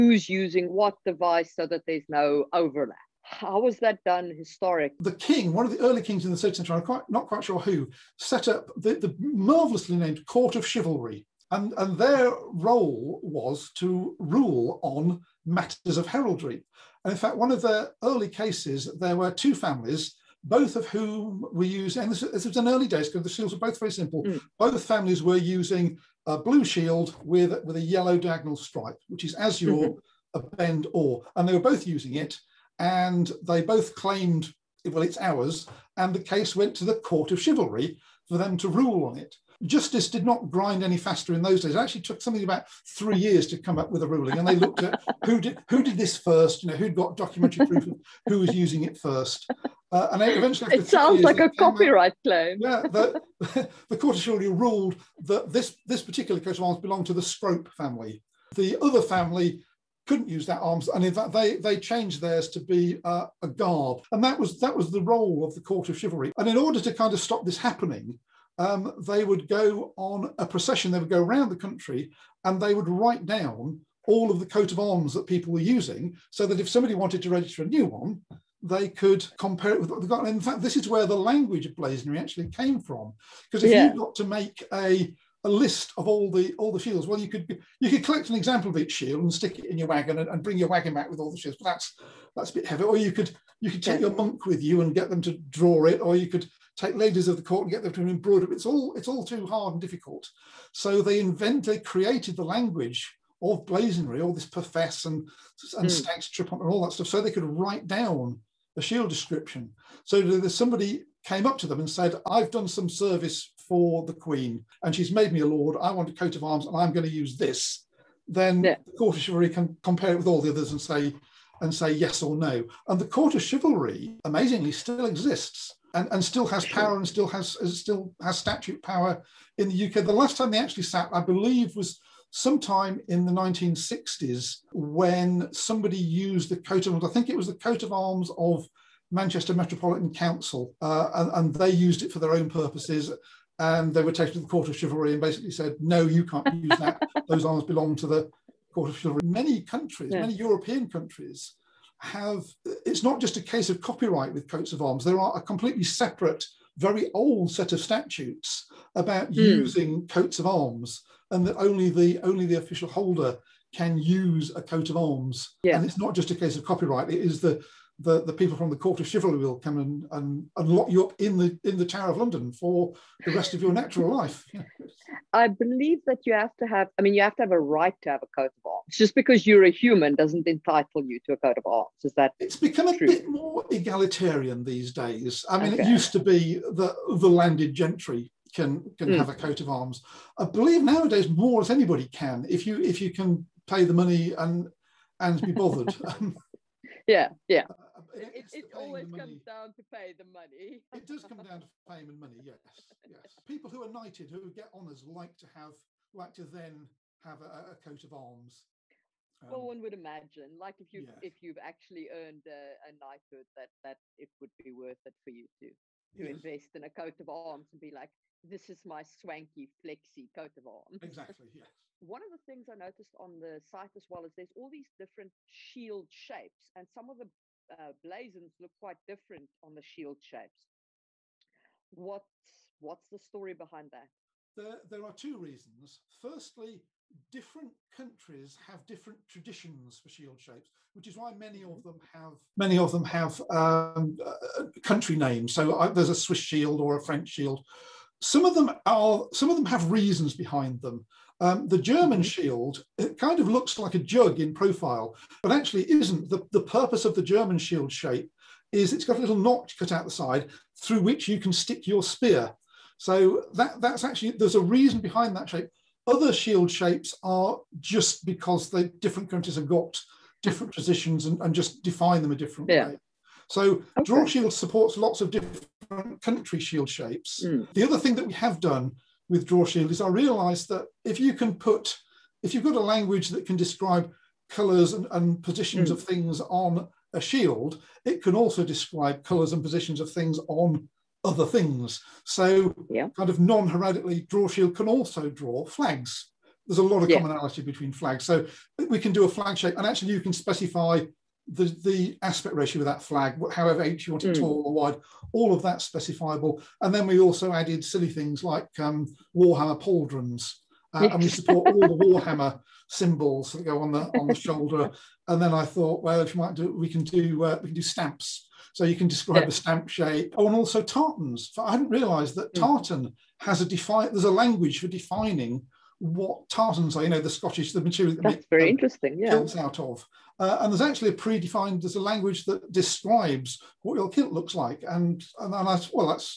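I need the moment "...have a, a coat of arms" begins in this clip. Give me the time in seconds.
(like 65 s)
207 s.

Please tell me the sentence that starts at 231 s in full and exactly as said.
What, what's the story behind that?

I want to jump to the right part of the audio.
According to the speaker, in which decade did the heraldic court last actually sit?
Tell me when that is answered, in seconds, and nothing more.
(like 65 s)
133 s.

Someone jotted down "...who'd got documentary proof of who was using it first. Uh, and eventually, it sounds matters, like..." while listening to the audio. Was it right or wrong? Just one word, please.
wrong.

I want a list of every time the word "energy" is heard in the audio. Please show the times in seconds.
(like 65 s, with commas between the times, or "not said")
not said.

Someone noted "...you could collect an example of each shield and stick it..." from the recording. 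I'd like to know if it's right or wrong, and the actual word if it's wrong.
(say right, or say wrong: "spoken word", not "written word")
right.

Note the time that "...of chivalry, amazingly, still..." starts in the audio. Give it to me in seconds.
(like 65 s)
123 s.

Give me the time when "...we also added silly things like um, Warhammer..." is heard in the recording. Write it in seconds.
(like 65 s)
307 s.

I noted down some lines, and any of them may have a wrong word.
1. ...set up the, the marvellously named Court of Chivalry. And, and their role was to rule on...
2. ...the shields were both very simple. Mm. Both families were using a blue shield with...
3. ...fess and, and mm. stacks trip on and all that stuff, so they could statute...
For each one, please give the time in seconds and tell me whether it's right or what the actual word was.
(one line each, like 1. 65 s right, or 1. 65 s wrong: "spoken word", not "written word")
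1. 8 s right
2. 23 s right
3. 104 s wrong: "write", not "statute".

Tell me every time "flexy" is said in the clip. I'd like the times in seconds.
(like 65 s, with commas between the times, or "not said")
219 s.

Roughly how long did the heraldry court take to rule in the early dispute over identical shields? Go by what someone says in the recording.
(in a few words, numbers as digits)
3 years.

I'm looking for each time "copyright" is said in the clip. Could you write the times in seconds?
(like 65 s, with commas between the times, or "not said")
51 s, 153 s, 166 s.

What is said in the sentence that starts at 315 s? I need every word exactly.
And then I thought, well, if you might do, we can do uh, we can do stamps.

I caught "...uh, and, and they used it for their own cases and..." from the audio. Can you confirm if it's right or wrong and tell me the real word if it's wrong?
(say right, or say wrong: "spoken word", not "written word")
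wrong: "purposes", not "cases".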